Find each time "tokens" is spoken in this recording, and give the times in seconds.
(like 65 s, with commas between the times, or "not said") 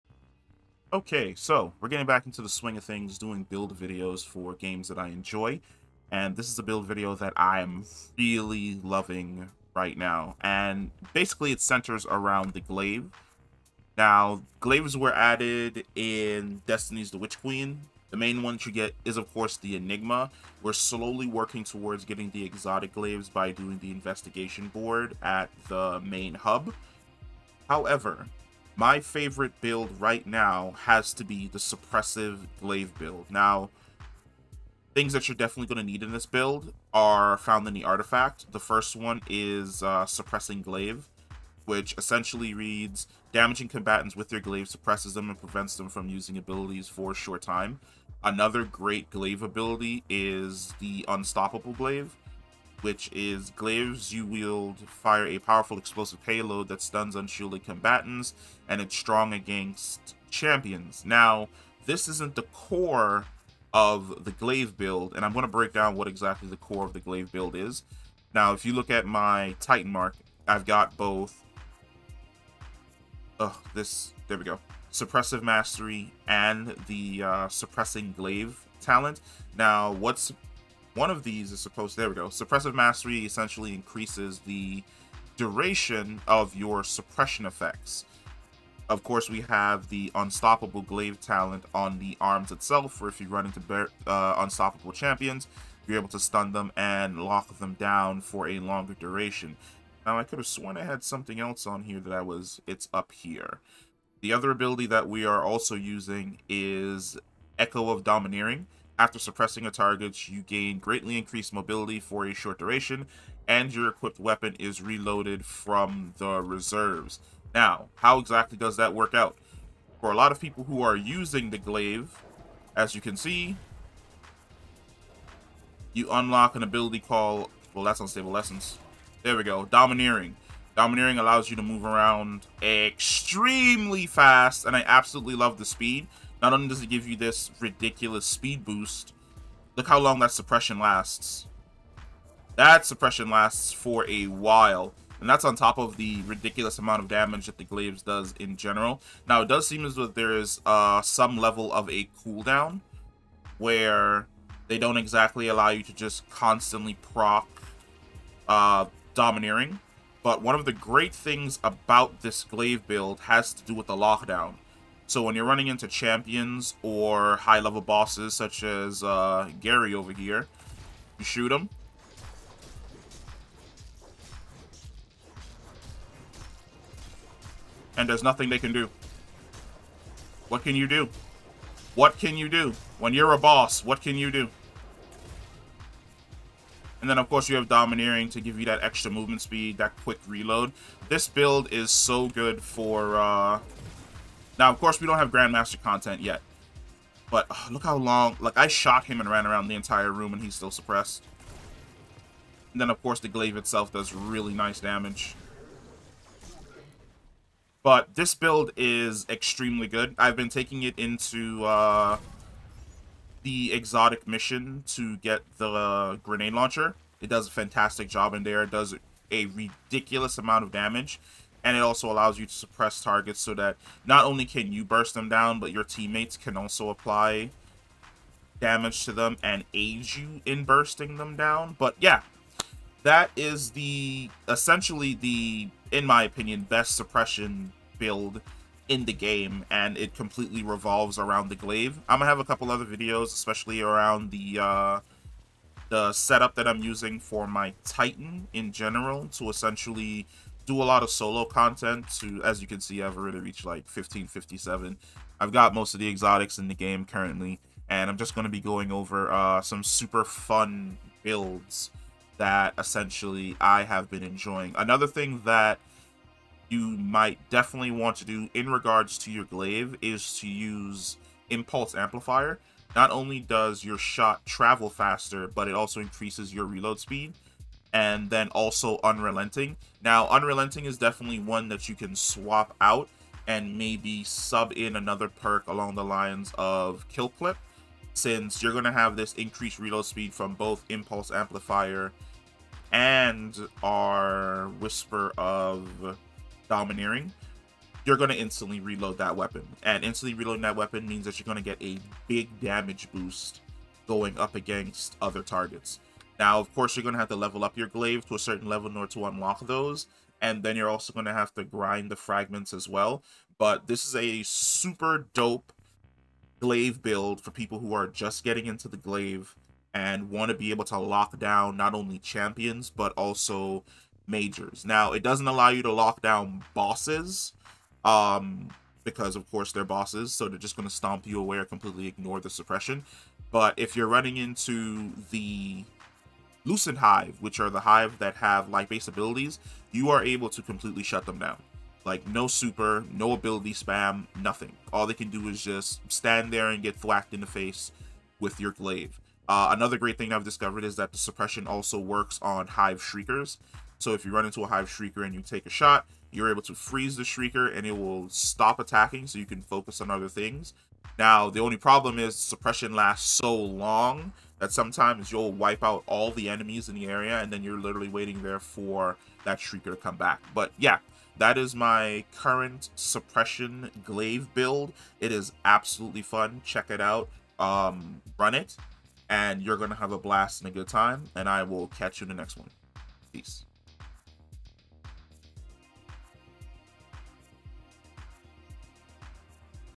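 not said.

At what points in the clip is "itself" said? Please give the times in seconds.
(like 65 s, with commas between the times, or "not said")
92 s, 203 s.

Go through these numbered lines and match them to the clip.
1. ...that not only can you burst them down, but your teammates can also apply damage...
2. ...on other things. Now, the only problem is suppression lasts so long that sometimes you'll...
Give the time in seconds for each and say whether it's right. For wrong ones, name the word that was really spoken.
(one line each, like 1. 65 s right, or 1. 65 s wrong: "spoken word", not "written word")
1. 223 s right
2. 360 s right.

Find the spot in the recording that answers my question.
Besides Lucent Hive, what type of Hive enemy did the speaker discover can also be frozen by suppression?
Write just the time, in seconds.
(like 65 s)
352 s.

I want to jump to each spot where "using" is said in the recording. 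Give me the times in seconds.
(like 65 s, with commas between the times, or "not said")
46 s, 105 s, 120 s, 246 s.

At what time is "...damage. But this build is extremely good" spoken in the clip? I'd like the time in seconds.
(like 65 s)
204 s.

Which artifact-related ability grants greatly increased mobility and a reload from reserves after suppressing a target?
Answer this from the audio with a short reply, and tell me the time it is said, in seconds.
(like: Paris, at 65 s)
Echo of Domineering, at 107 s.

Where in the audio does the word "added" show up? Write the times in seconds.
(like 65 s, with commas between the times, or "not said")
15 s.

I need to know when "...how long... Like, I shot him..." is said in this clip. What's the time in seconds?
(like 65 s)
197 s.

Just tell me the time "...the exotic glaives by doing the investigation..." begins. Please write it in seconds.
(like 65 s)
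22 s.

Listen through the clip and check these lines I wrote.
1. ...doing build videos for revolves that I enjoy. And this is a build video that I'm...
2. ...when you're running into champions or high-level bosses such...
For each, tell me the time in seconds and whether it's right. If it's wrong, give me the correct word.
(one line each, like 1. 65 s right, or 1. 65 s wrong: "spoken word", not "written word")
1. 3 s wrong: "games", not "revolves"
2. 165 s right.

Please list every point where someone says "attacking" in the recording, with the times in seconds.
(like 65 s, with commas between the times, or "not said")
358 s.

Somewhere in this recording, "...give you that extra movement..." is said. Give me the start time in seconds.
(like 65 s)
188 s.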